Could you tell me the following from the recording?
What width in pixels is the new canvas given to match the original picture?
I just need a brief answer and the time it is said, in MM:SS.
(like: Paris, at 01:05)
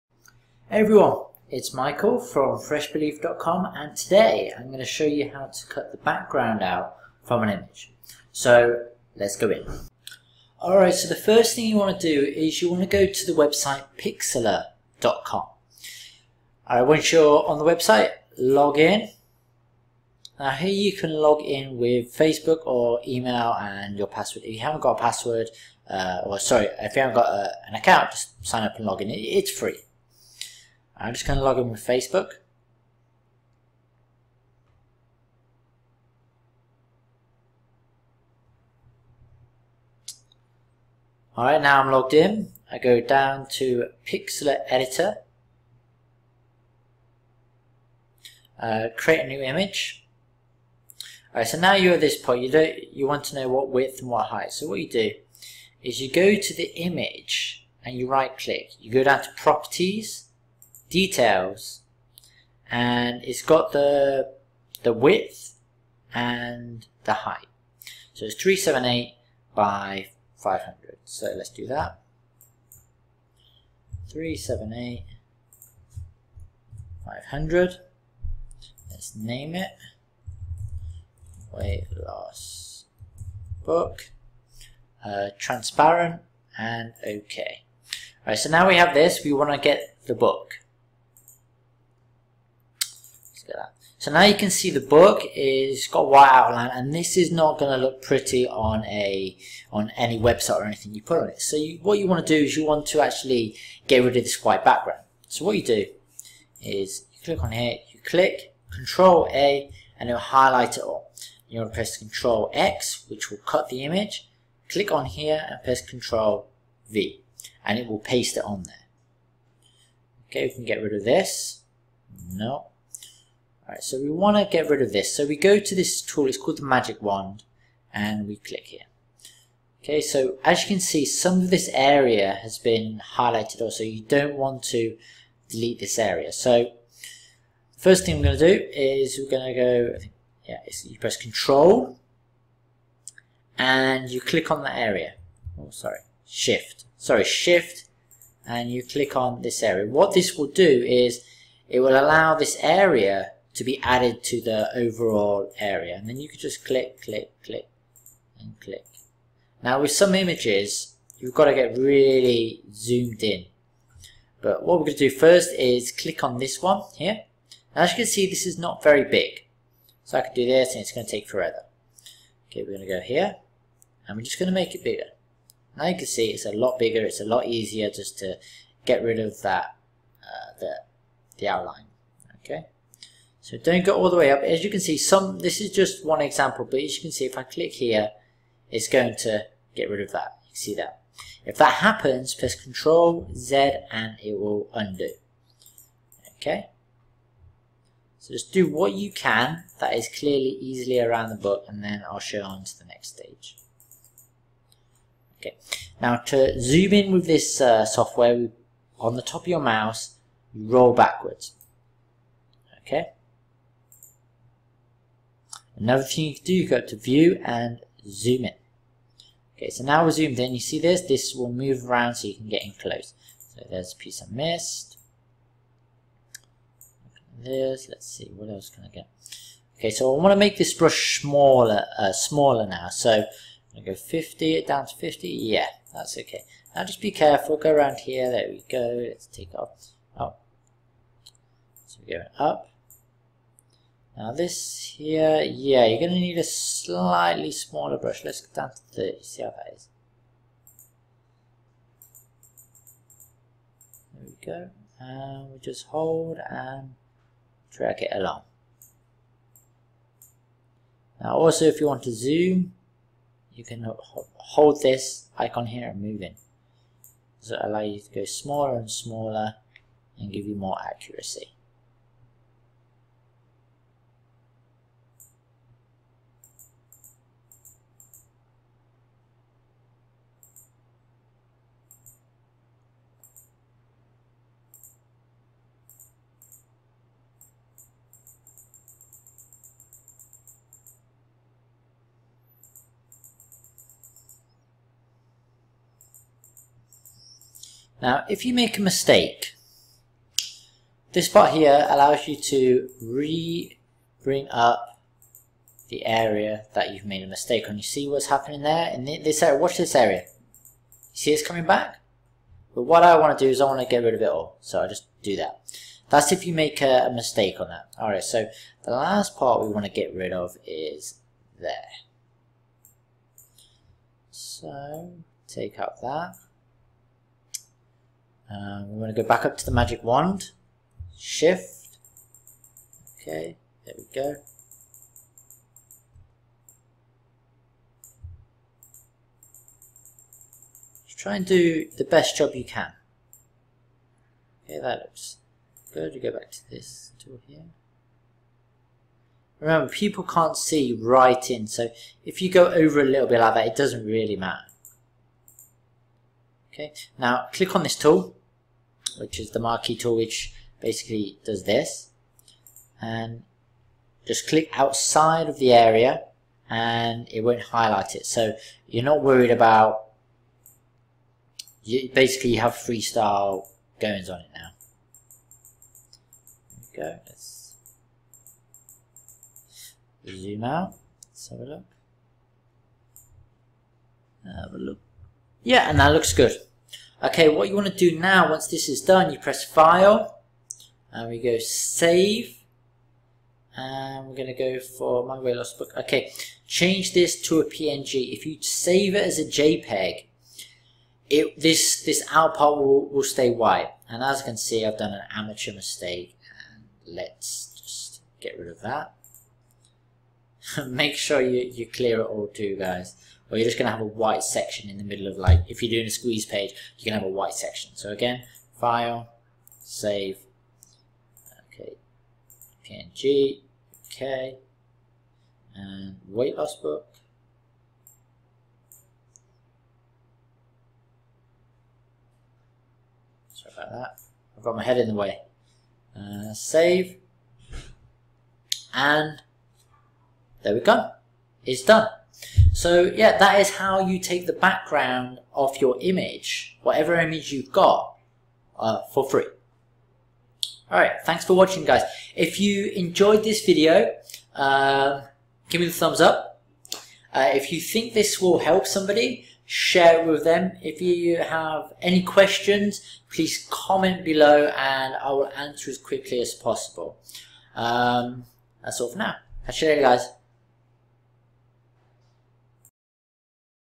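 378, at 01:08.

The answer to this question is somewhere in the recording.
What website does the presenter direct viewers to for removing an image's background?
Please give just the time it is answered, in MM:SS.
00:13.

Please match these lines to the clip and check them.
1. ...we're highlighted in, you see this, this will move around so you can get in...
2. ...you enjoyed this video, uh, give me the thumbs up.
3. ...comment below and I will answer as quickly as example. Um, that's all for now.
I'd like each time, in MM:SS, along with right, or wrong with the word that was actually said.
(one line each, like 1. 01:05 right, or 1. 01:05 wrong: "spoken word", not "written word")
1. 03:40 wrong: "zoomed", not "highlighted"
2. 07:32 right
3. 07:43 wrong: "possible", not "example".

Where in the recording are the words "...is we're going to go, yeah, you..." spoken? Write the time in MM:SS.
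02:18.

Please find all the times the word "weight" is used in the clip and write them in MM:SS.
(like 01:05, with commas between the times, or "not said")
01:21, 06:35, 07:06.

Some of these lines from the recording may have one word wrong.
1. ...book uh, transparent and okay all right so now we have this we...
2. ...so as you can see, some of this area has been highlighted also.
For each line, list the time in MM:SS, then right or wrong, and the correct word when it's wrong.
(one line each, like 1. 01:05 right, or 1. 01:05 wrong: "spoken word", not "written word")
1. 01:23 right
2. 02:10 right.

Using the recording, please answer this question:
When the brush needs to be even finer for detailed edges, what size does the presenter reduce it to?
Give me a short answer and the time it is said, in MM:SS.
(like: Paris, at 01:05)
30, at 04:08.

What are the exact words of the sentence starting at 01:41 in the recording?
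So you, what you want to do is you want to actually get rid of this white background.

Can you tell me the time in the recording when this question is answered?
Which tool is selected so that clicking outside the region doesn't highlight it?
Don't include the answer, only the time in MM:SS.
05:59.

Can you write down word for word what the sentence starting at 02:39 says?
Now with some images, you've got to get really zoomed in.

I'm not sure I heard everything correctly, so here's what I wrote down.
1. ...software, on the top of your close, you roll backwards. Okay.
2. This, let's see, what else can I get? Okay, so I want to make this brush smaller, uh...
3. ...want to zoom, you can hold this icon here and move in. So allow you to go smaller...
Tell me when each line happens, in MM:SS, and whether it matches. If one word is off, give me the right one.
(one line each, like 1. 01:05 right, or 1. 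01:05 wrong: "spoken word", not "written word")
1. 03:27 wrong: "mouse", not "close"
2. 03:47 right
3. 04:21 right.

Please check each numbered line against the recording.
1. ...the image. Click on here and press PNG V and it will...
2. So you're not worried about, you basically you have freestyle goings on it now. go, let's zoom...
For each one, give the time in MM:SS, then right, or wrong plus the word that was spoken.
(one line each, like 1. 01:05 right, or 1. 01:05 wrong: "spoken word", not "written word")
1. 01:53 wrong: "Control", not "PNG"
2. 06:08 right.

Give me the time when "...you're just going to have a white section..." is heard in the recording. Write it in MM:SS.
06:53.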